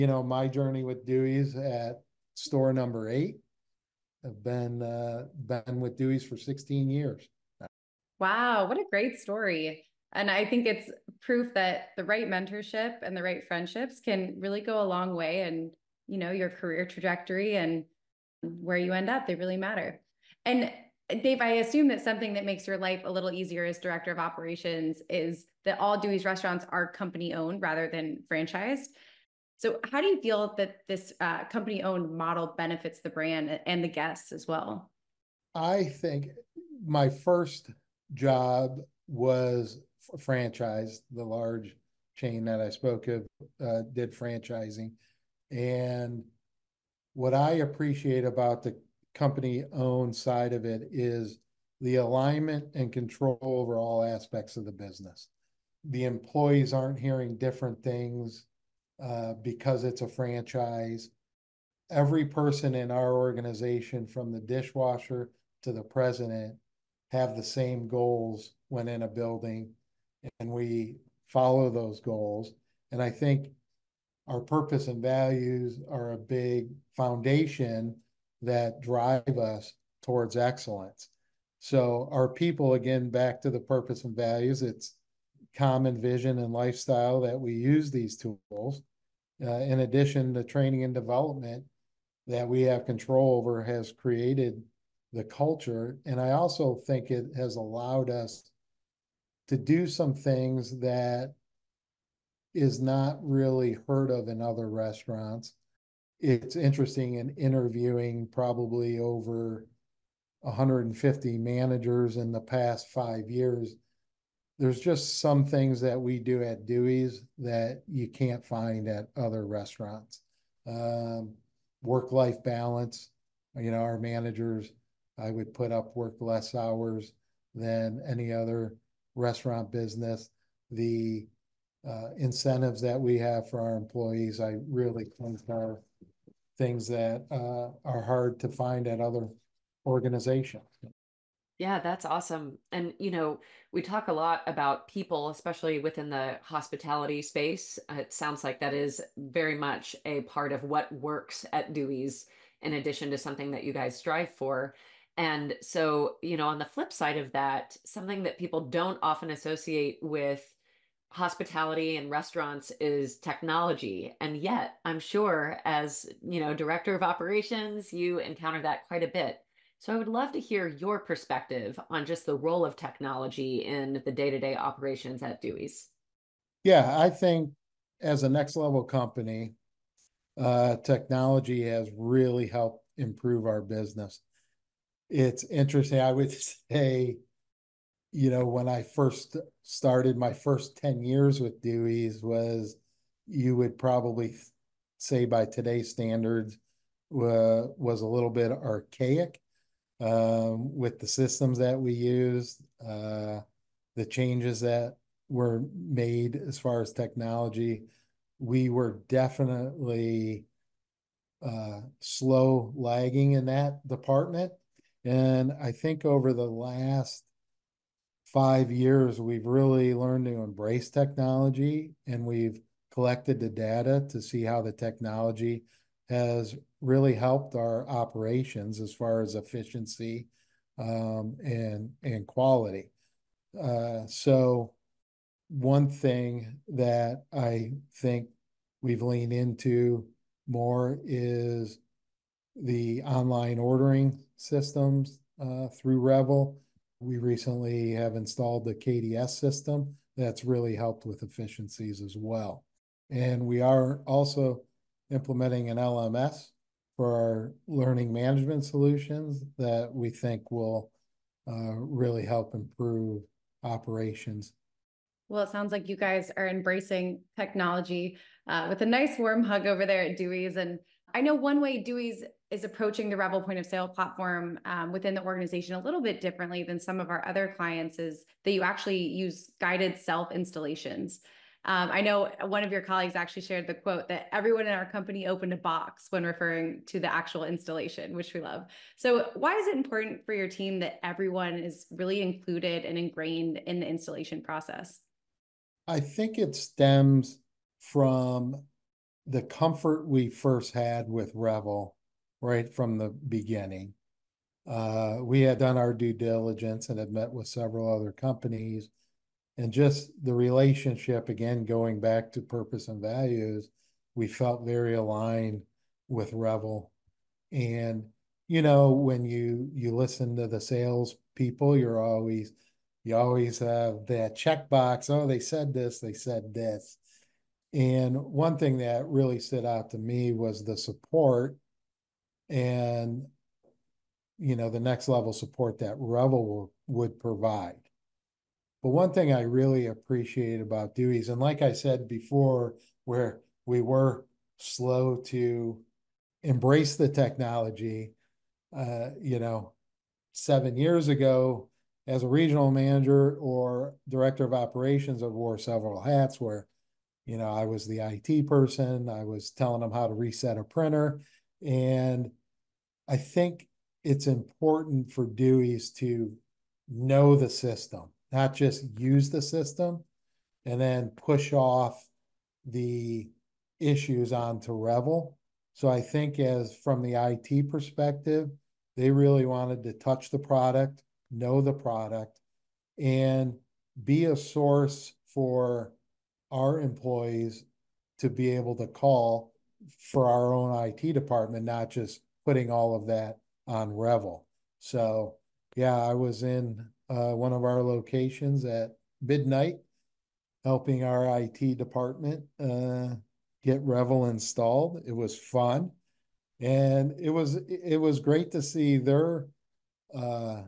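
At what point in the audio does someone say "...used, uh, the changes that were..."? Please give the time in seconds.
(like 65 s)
201 s.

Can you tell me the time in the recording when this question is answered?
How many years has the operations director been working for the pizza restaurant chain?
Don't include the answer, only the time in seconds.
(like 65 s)
6 s.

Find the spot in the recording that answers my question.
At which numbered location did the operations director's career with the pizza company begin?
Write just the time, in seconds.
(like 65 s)
2 s.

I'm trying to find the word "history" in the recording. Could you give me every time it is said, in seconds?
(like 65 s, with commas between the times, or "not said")
not said.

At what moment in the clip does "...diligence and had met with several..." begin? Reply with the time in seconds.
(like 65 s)
306 s.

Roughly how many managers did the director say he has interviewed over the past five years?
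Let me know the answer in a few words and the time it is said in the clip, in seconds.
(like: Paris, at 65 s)
Over 150, at 108 s.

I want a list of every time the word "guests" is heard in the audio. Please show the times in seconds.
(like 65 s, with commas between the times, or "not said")
33 s.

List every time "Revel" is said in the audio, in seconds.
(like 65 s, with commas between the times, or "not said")
245 s, 273 s, 301 s, 316 s, 335 s, 374 s, 393 s, 403 s.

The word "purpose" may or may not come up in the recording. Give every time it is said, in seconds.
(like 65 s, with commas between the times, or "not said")
74 s, 83 s, 312 s.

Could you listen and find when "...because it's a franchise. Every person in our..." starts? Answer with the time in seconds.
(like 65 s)
59 s.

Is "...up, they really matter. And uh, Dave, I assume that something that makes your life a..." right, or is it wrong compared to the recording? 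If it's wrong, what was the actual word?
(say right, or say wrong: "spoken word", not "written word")
right.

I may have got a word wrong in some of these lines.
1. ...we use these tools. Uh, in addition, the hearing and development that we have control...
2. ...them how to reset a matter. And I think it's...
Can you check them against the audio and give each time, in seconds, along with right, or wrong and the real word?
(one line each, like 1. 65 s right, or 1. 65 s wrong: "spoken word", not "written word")
1. 87 s wrong: "training", not "hearing"
2. 359 s wrong: "printer", not "matter".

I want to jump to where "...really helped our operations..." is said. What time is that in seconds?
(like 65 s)
226 s.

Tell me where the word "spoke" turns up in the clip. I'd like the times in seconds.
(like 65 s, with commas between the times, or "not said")
42 s.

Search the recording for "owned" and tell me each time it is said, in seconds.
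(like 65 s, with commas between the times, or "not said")
27 s, 31 s, 49 s.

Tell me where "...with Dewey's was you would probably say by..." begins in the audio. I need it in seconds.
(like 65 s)
191 s.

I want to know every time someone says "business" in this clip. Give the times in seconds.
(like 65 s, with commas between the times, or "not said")
54 s, 129 s, 183 s.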